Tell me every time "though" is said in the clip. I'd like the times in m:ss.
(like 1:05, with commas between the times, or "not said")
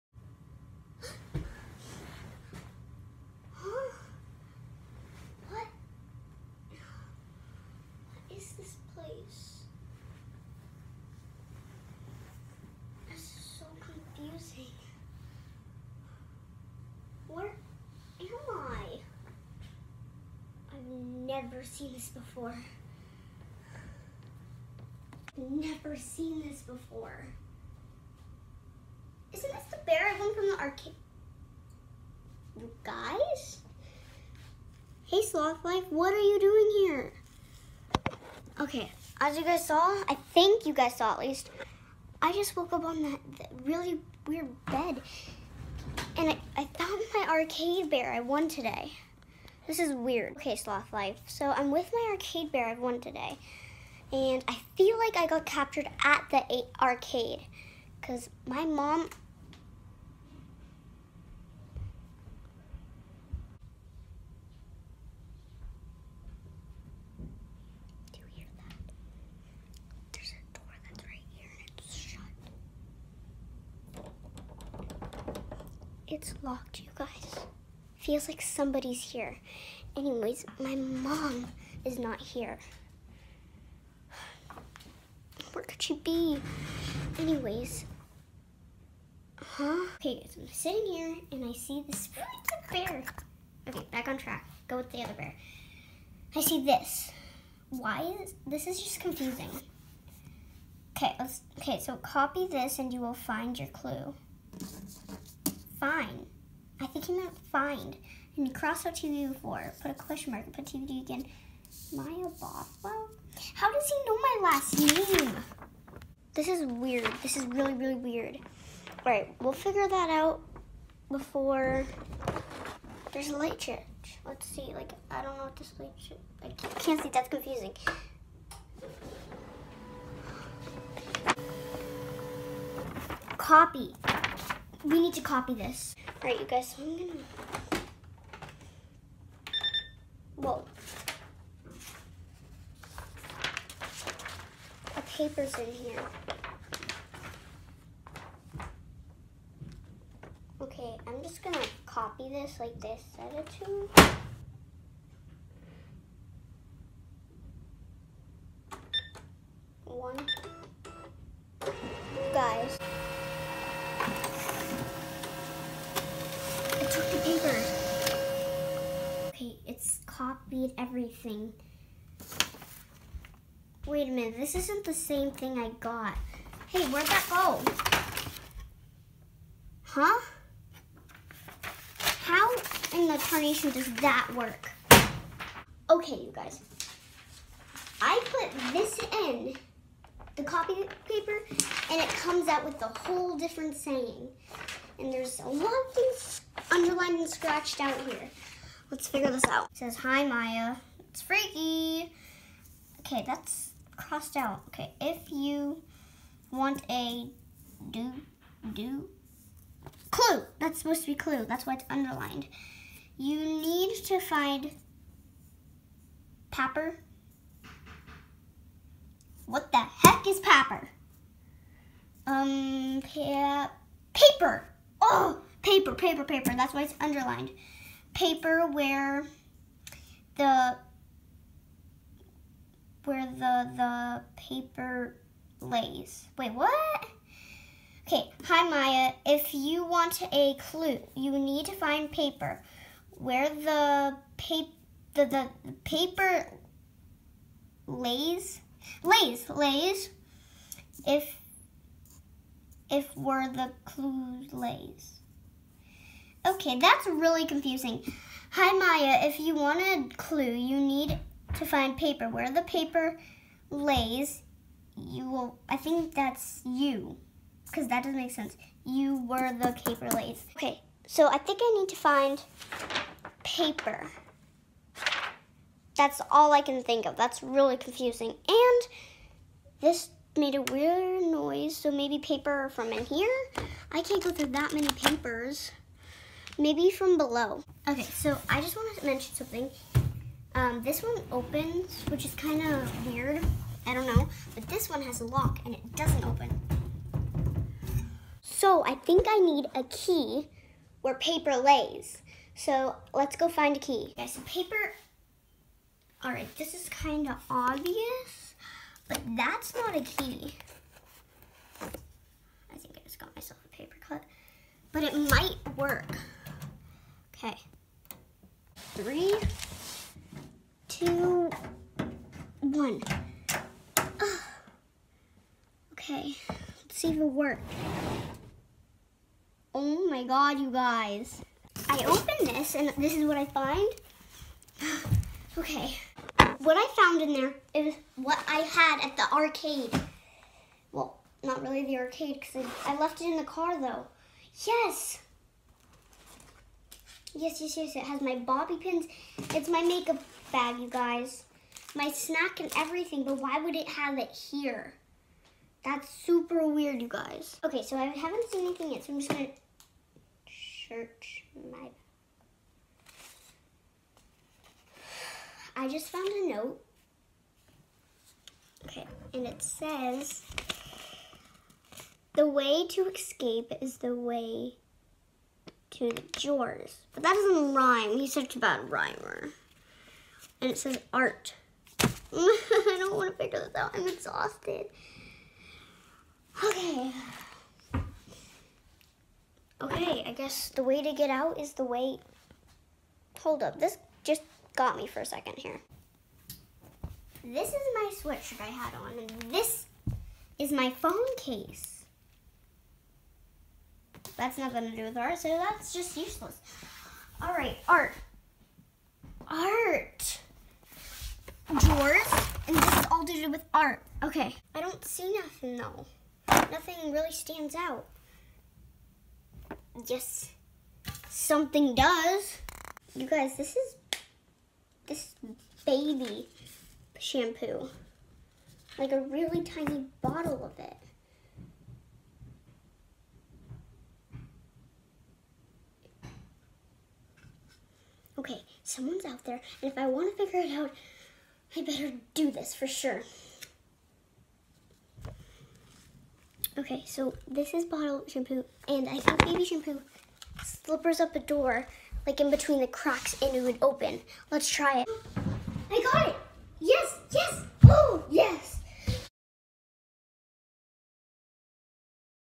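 5:43, 6:55.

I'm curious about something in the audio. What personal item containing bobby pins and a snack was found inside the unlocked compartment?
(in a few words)
Makeup bag.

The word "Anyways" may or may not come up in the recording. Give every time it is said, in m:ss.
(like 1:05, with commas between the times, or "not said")
1:19, 1:27.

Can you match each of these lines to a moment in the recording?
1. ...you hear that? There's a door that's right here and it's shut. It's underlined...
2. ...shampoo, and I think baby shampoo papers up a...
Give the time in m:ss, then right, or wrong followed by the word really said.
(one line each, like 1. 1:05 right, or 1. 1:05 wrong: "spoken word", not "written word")
1. 1:08 wrong: "locked", not "underlined"
2. 7:28 wrong: "slippers", not "papers".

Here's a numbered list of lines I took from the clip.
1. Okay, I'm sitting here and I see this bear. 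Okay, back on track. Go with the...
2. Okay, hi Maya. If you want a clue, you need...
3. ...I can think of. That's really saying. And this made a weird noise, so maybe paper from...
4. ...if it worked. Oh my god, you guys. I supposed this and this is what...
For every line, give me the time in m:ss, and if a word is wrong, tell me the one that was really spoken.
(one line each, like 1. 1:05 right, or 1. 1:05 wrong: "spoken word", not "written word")
1. 1:29 right
2. 3:58 right
3. 4:36 wrong: "confusing", not "saying"
4. 5:27 wrong: "opened", not "supposed".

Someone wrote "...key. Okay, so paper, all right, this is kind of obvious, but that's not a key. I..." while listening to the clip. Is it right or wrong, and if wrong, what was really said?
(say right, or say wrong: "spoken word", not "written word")
right.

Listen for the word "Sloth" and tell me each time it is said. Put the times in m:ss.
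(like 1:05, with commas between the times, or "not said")
0:35, 0:50.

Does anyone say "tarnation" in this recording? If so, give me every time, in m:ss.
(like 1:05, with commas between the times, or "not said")
3:03.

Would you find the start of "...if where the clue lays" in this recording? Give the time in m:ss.
4:12.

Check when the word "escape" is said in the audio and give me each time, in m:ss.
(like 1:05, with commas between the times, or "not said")
6:13.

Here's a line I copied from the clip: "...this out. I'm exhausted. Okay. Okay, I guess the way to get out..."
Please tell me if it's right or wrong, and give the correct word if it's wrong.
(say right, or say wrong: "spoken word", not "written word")
right.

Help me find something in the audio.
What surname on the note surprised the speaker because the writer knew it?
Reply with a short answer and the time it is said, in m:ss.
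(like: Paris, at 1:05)
Bothwell, at 1:52.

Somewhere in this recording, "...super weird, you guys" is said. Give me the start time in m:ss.
5:56.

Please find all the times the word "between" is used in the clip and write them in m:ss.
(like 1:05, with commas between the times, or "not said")
7:32.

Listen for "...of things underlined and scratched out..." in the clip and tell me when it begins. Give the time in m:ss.
3:15.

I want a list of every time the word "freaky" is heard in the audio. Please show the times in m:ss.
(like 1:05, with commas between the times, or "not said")
3:21.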